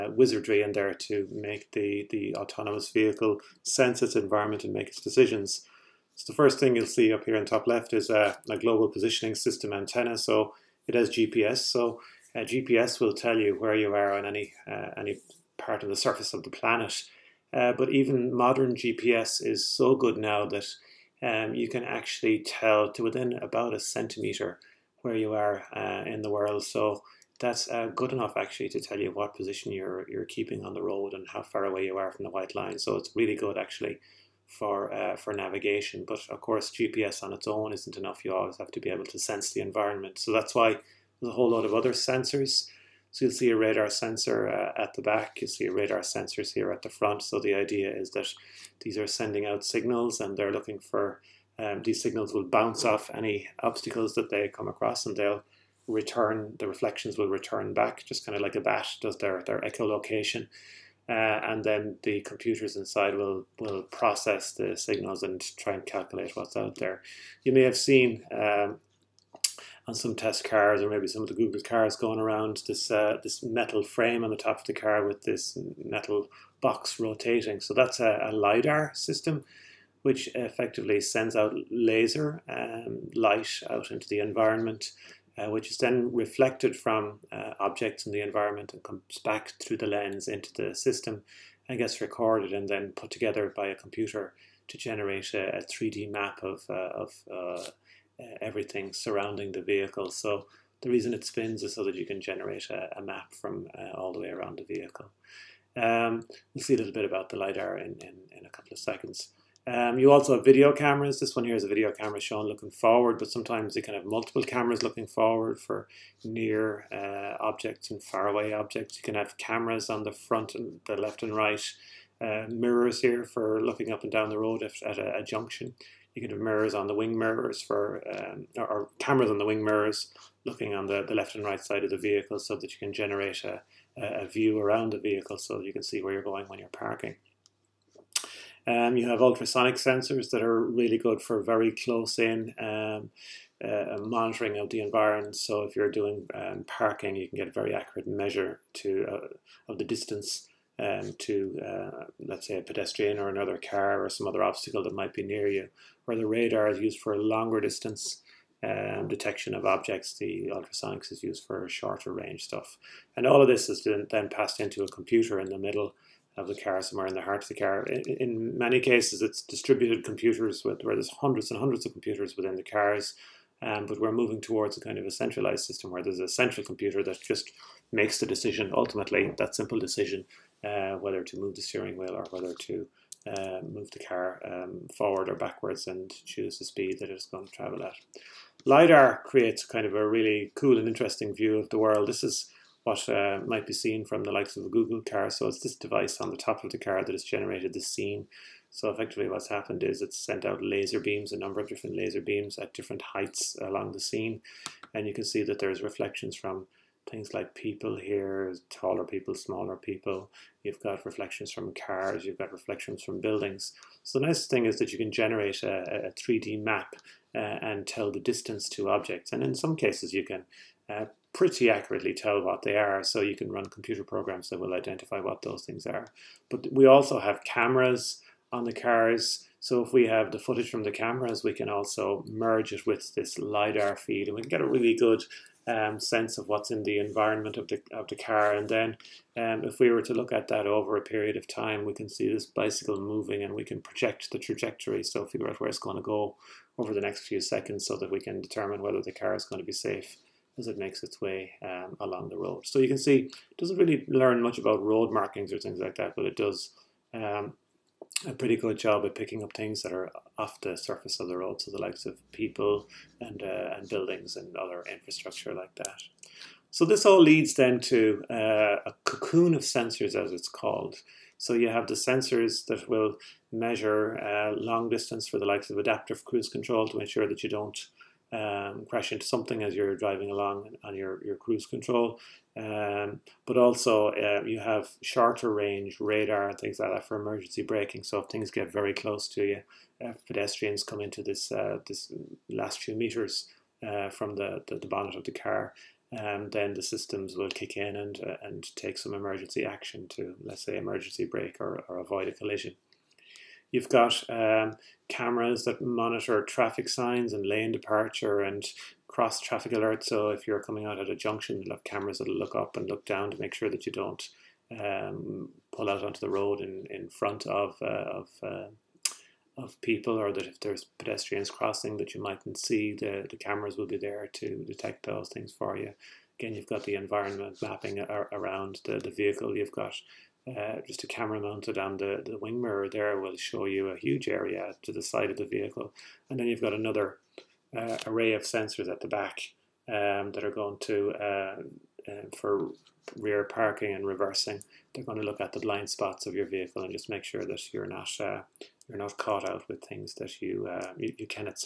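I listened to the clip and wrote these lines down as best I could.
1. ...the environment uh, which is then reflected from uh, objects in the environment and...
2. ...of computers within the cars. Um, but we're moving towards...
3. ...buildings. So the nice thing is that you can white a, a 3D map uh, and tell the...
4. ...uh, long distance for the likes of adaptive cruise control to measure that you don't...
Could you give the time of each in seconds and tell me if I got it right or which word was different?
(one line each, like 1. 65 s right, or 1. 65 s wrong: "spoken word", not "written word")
1. 84 s right
2. 171 s right
3. 213 s wrong: "generate", not "white"
4. 274 s wrong: "ensure", not "measure".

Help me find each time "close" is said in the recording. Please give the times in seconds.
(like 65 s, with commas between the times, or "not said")
141 s, 288 s.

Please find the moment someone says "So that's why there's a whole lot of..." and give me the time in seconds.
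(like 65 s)
40 s.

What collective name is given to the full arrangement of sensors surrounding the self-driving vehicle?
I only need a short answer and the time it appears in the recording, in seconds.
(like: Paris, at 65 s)
cocoon of sensors, at 269 s.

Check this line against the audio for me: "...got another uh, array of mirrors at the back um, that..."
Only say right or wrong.
wrong.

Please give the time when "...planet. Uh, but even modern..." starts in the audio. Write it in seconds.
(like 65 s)
16 s.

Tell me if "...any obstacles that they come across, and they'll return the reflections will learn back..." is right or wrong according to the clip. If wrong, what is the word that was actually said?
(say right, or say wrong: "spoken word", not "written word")
wrong: "return", not "learn".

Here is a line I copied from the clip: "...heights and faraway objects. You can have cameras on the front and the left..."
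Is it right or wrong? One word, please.
wrong.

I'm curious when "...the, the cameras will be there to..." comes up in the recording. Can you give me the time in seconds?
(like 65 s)
322 s.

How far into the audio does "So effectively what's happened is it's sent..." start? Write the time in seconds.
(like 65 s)
198 s.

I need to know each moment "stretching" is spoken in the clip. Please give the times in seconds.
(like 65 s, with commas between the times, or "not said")
not said.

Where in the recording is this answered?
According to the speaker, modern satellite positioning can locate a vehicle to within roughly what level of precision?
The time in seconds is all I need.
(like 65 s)
23 s.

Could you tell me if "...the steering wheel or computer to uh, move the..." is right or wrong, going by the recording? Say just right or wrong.
wrong.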